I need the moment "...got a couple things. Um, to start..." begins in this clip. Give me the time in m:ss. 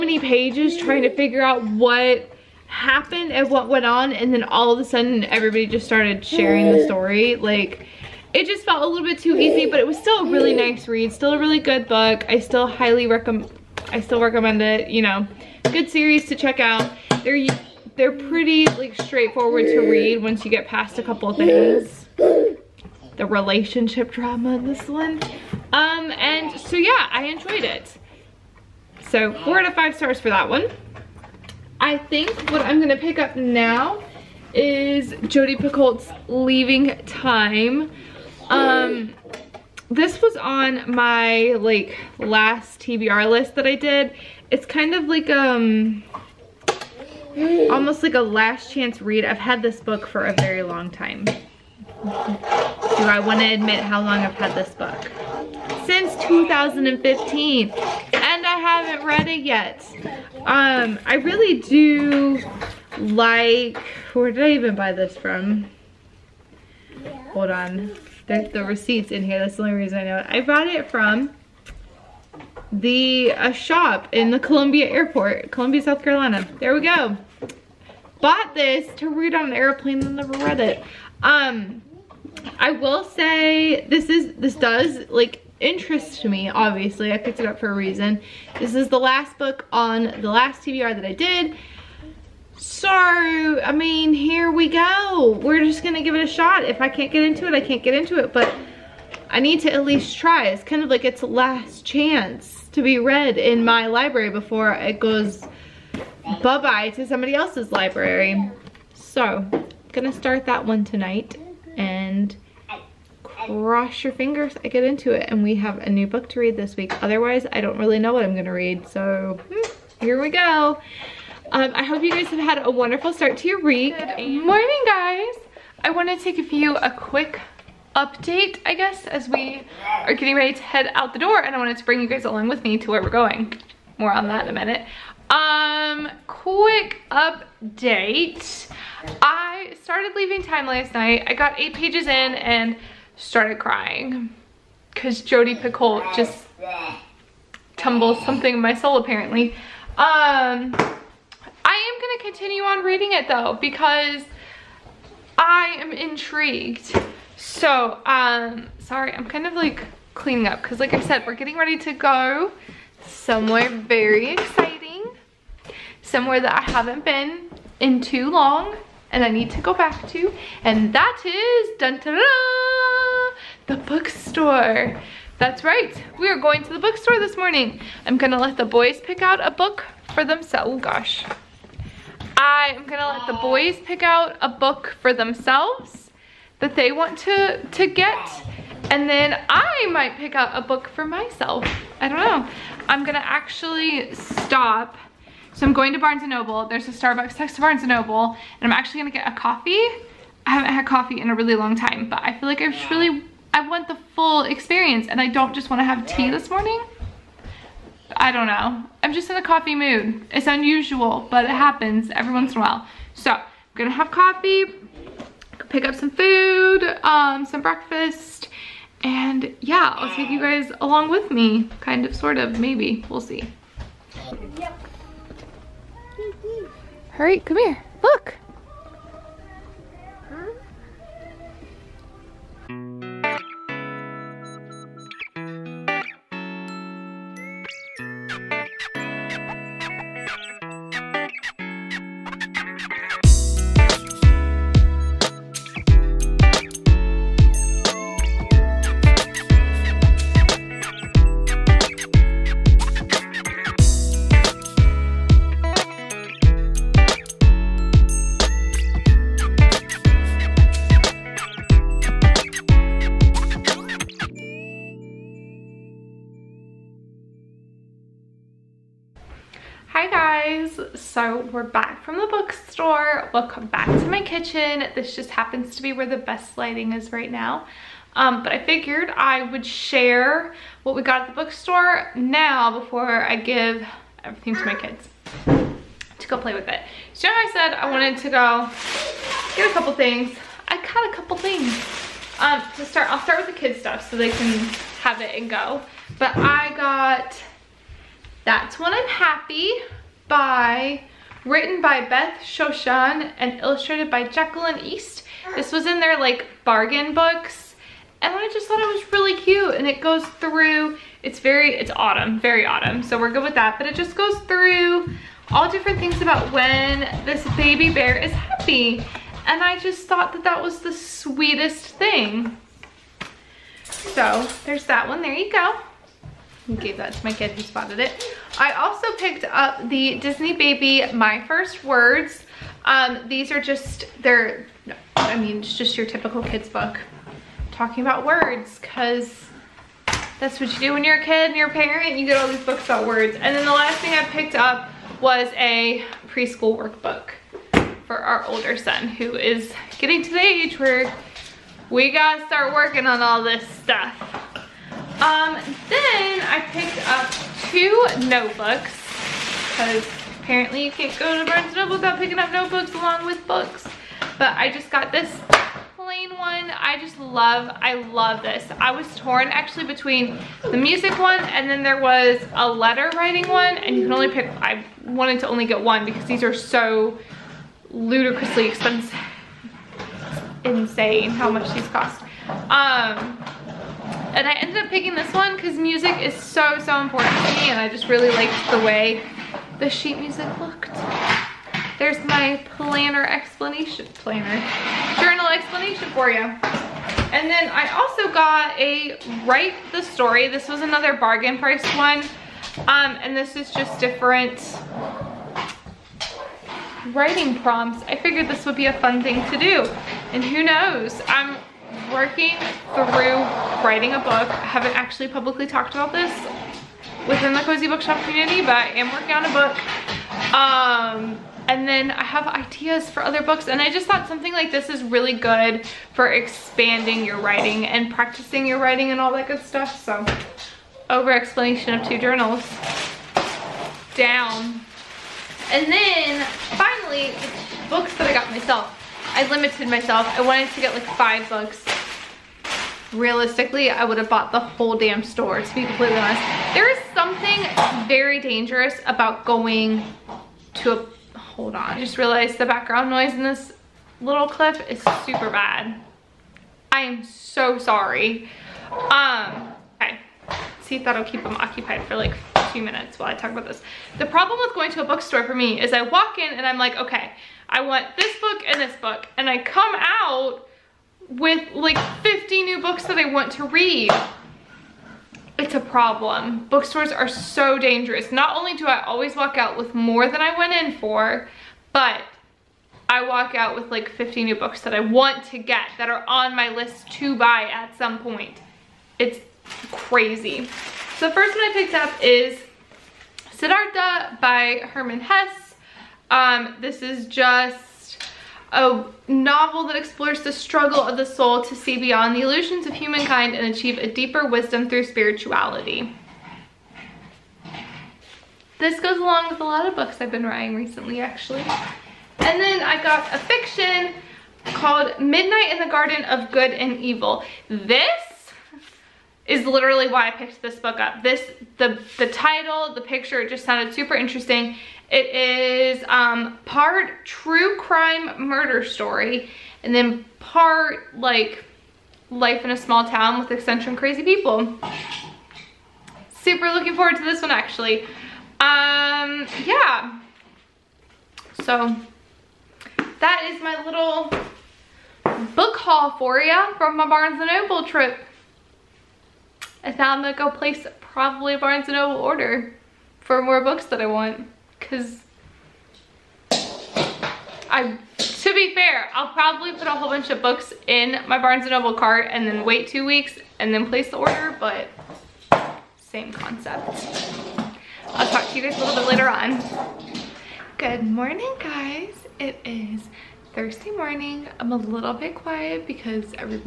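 4:50.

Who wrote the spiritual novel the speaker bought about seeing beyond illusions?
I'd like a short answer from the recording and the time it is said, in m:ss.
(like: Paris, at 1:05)
Herman Hesse, at 8:14.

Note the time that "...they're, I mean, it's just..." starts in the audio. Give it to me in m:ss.
5:34.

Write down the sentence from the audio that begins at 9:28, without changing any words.
I'll talk to you guys a little bit later on.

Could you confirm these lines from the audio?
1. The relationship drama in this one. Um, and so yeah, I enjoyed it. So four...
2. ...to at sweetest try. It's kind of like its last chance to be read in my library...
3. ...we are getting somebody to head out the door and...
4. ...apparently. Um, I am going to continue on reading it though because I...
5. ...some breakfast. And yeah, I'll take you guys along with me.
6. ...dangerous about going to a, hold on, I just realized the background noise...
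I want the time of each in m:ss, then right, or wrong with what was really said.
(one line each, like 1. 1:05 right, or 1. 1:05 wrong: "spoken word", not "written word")
1. 0:22 right
2. 1:39 wrong: "least", not "sweetest"
3. 2:09 wrong: "ready", not "somebody"
4. 2:28 right
5. 3:37 right
6. 7:28 right.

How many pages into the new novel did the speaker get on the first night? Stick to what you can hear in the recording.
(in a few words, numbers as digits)
8.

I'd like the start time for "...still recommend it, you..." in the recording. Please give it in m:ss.
0:13.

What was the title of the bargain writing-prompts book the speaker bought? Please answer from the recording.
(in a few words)
Write the Story.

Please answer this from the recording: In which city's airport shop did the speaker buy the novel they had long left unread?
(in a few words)
Columbia, South Carolina.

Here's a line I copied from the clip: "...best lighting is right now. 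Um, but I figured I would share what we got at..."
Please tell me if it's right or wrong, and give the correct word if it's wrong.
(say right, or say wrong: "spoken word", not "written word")
right.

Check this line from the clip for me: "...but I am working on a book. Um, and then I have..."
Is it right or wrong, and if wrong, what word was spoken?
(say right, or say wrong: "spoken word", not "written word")
right.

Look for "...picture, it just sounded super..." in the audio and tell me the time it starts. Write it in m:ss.
8:43.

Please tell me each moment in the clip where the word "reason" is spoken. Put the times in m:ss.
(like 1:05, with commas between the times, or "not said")
1:09, 1:27.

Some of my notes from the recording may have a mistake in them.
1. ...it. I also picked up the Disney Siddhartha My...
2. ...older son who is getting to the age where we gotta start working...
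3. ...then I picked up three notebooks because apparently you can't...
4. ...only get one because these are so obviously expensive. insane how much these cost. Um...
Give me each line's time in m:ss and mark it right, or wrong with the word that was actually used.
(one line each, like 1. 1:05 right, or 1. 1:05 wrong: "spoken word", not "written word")
1. 5:27 wrong: "Baby", not "Siddhartha"
2. 5:48 right
3. 5:55 wrong: "two", not "three"
4. 6:15 wrong: "ludicrously", not "obviously".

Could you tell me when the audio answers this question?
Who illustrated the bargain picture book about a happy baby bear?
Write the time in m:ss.
5:04.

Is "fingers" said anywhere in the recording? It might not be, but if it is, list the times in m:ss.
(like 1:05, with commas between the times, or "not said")
1:54.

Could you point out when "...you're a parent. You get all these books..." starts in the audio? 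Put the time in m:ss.
5:41.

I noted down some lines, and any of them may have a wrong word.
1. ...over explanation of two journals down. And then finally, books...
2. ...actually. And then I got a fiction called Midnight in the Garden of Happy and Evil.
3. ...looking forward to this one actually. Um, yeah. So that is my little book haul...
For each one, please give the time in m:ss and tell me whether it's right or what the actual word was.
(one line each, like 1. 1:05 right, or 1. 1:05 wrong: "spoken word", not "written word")
1. 7:11 right
2. 8:31 wrong: "Good", not "Happy"
3. 8:56 right.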